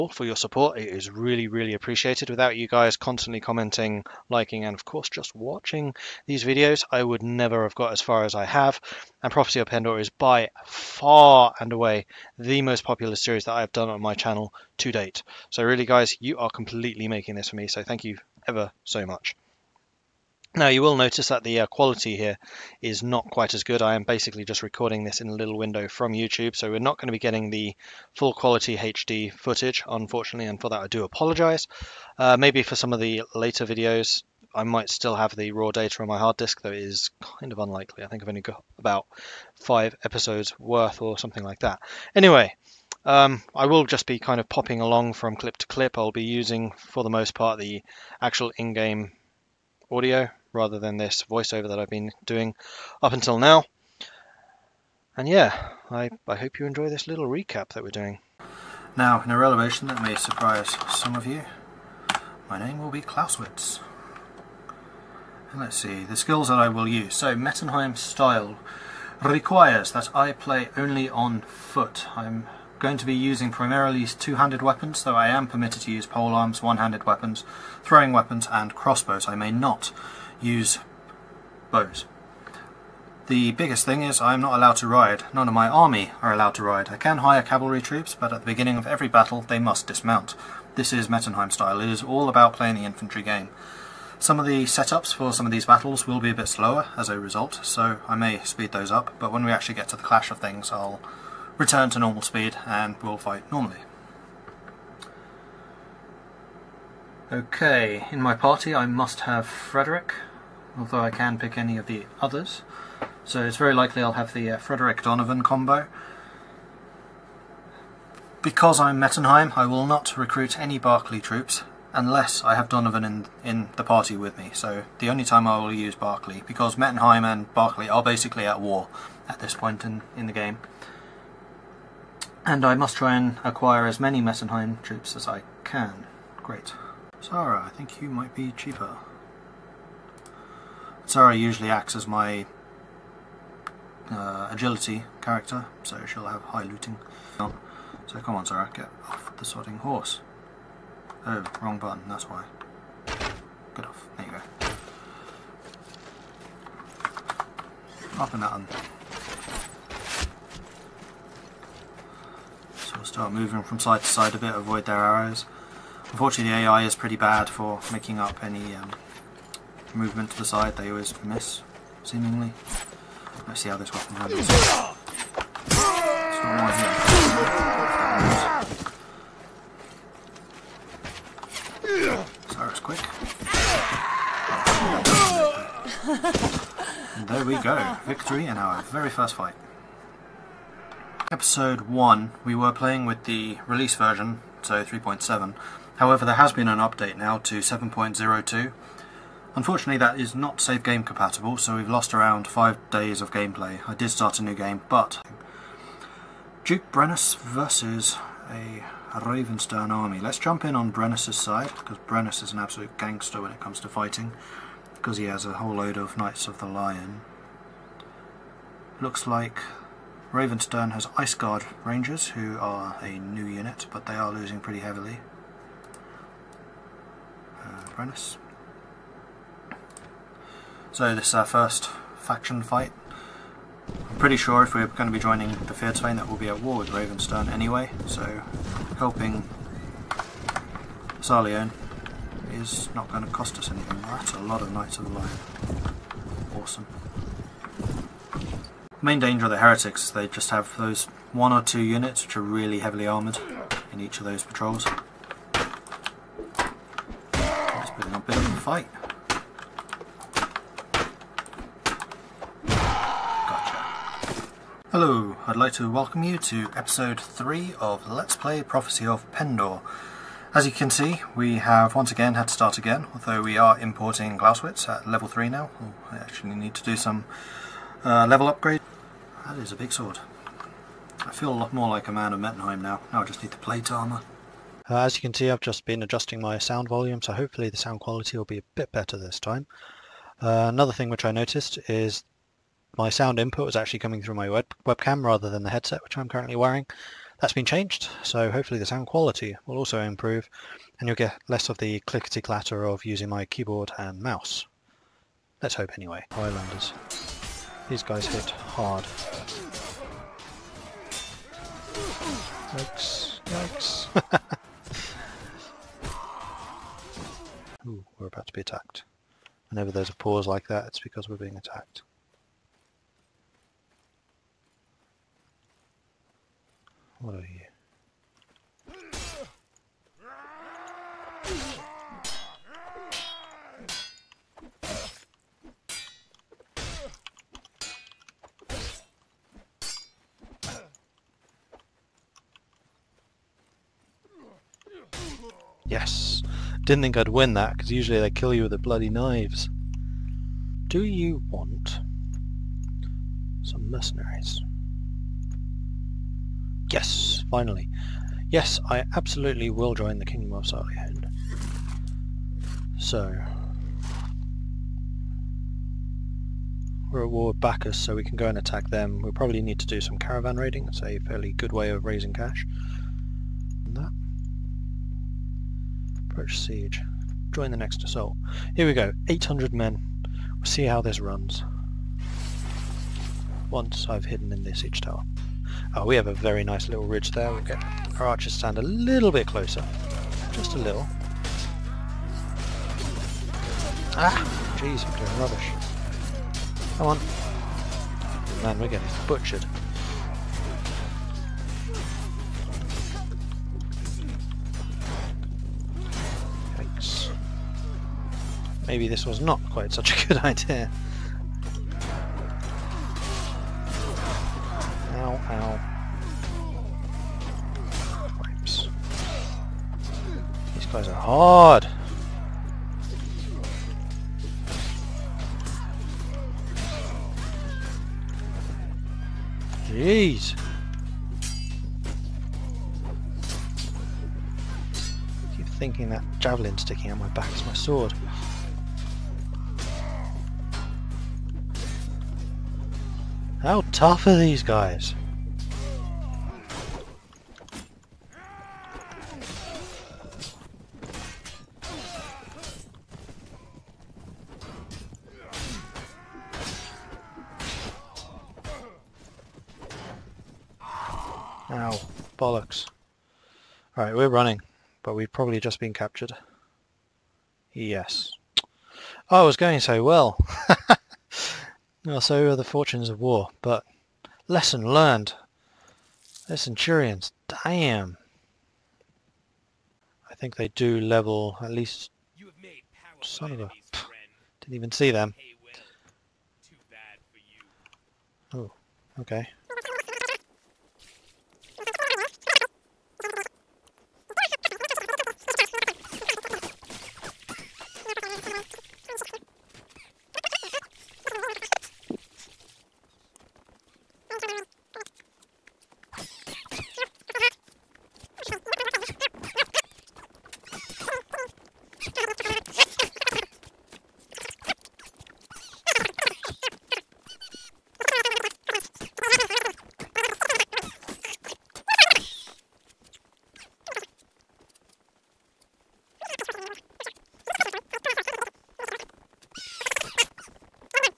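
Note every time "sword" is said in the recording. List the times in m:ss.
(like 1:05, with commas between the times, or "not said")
4:39, 7:17.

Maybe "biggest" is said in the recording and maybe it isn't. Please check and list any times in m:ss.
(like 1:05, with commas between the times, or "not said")
1:23.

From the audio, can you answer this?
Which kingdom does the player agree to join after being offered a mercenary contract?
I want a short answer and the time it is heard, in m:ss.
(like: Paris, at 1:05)
Kingdom of Sarleon, at 6:00.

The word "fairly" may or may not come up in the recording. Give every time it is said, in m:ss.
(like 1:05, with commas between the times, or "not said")
6:11.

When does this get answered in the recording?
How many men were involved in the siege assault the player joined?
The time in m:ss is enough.
6:19.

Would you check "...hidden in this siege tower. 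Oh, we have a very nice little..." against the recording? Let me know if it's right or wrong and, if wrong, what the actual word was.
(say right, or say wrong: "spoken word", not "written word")
right.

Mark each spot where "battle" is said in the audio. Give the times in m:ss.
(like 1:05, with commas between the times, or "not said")
1:29, 1:35.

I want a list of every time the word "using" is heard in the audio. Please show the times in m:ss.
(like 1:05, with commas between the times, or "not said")
0:46, 1:13, 5:03.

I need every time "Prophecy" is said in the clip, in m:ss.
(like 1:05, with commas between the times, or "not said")
0:09, 4:28.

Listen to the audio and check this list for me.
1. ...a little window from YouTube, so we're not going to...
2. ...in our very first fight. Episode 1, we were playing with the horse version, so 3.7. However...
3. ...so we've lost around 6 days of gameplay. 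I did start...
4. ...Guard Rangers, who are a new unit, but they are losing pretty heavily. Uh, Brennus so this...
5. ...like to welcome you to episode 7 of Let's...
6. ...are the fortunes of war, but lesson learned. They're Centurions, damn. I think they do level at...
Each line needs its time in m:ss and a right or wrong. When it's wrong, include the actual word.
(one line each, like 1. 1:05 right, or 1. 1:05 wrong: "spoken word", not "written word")
1. 0:25 right
2. 3:08 wrong: "release", not "horse"
3. 3:21 wrong: "5", not "6"
4. 3:41 right
5. 4:25 wrong: "3", not "7"
6. 7:52 right.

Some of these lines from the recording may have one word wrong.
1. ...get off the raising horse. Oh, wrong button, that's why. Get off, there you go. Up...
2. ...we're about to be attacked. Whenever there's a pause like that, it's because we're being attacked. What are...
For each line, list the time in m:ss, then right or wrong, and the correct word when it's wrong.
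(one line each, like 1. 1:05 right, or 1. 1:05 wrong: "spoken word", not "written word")
1. 2:28 wrong: "sodding", not "raising"
2. 5:18 right.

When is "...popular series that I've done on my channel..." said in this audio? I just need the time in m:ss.
0:12.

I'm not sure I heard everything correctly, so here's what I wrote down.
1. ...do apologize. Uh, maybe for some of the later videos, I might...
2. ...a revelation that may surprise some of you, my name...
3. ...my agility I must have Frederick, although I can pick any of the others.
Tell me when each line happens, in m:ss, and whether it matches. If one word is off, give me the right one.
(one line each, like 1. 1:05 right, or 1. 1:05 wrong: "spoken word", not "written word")
1. 0:30 right
2. 0:59 right
3. 1:48 wrong: "party", not "agility".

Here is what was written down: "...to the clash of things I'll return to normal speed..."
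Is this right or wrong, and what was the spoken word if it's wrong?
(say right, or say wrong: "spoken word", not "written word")
right.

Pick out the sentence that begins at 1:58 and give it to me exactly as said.
Because I'm Mettenheim, I will not recruit any Barclay troops unless I have Donovan in, in the party with me.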